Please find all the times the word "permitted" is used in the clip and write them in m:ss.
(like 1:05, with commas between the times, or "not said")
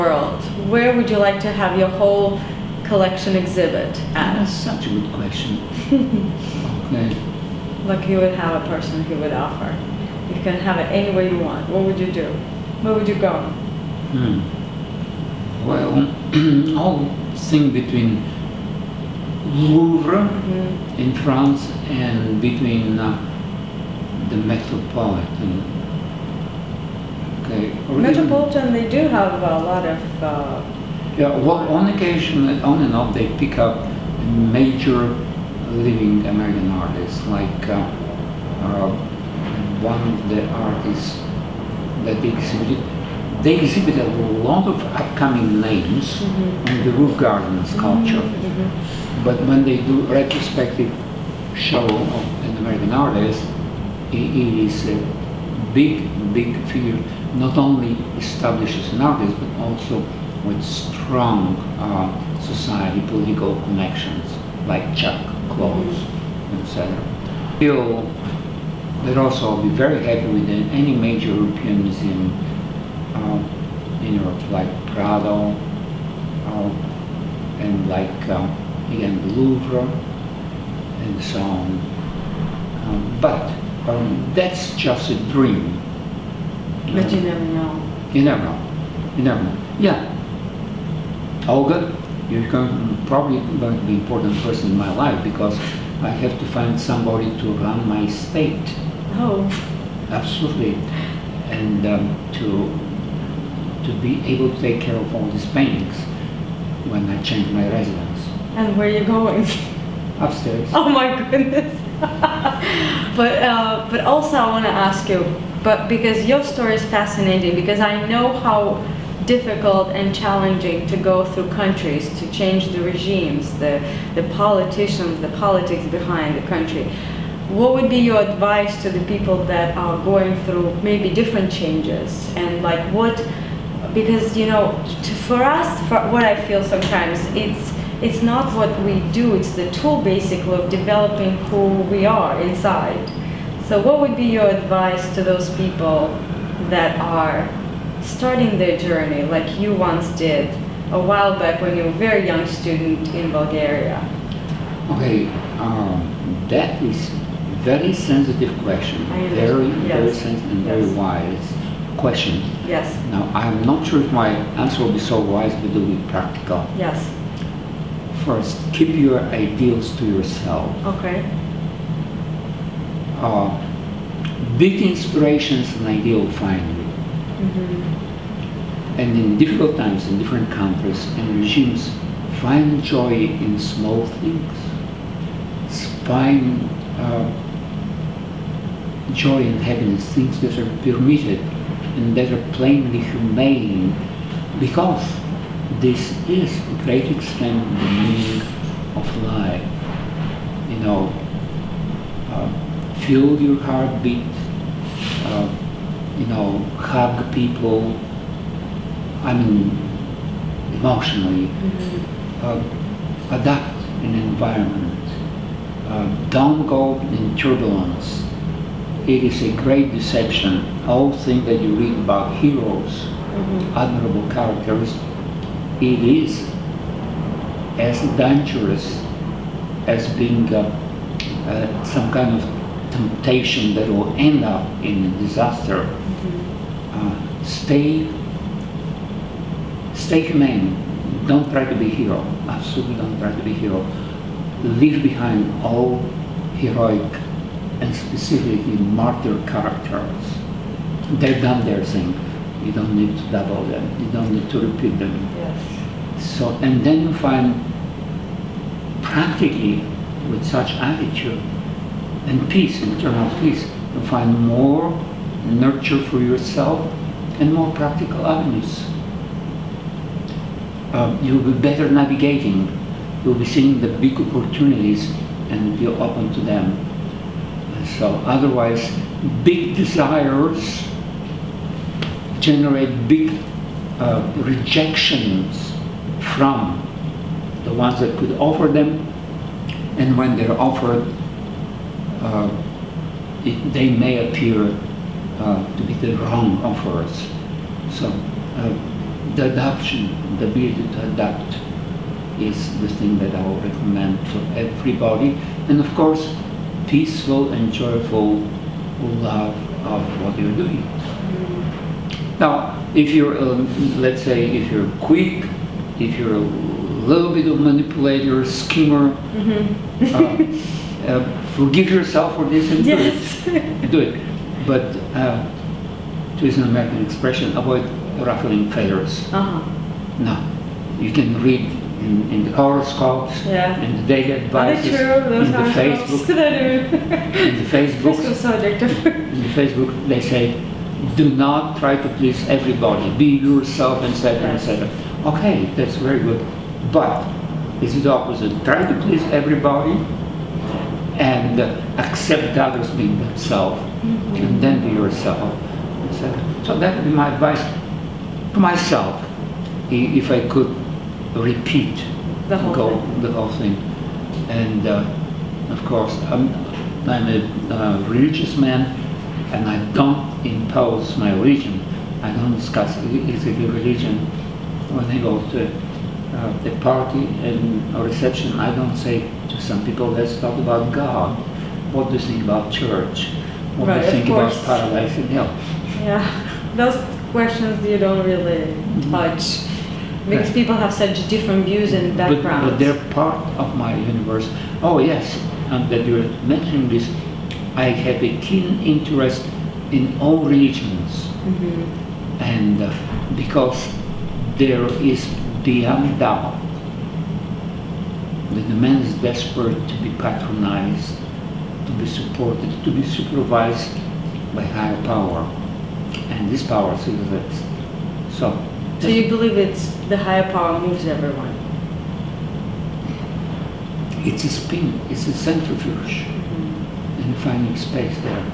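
3:10.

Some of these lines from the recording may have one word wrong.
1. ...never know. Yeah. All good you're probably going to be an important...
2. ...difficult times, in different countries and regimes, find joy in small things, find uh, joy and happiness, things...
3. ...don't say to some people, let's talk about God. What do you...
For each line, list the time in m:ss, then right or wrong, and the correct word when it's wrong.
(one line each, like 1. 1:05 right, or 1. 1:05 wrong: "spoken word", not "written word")
1. 1:29 right
2. 2:59 right
3. 6:18 right.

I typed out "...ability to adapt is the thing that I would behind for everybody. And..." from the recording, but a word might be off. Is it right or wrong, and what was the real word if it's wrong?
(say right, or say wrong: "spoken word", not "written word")
wrong: "recommend", not "behind".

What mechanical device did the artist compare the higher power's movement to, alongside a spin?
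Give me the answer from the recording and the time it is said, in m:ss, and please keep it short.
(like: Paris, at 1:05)
centrifuge, at 7:05.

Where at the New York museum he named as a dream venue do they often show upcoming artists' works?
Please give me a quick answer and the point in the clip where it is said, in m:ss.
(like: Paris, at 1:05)
roof garden, at 0:46.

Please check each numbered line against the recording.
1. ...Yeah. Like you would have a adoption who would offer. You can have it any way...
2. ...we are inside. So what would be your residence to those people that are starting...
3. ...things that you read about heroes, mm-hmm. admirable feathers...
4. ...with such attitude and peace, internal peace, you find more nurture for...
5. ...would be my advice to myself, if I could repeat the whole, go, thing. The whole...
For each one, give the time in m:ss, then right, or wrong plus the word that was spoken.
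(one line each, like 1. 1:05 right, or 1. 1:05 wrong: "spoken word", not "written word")
1. 0:06 wrong: "person", not "adoption"
2. 2:21 wrong: "advice", not "residence"
3. 3:41 wrong: "characters", not "feathers"
4. 4:20 right
5. 5:56 right.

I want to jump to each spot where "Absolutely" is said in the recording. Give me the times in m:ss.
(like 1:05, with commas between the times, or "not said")
1:40, 4:02.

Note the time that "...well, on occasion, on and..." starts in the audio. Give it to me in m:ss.
0:31.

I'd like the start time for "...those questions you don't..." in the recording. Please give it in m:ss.
6:26.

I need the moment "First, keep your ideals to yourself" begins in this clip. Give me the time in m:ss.
2:48.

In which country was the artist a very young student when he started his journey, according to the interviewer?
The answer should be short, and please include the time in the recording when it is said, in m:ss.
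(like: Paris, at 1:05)
Bulgaria, at 2:33.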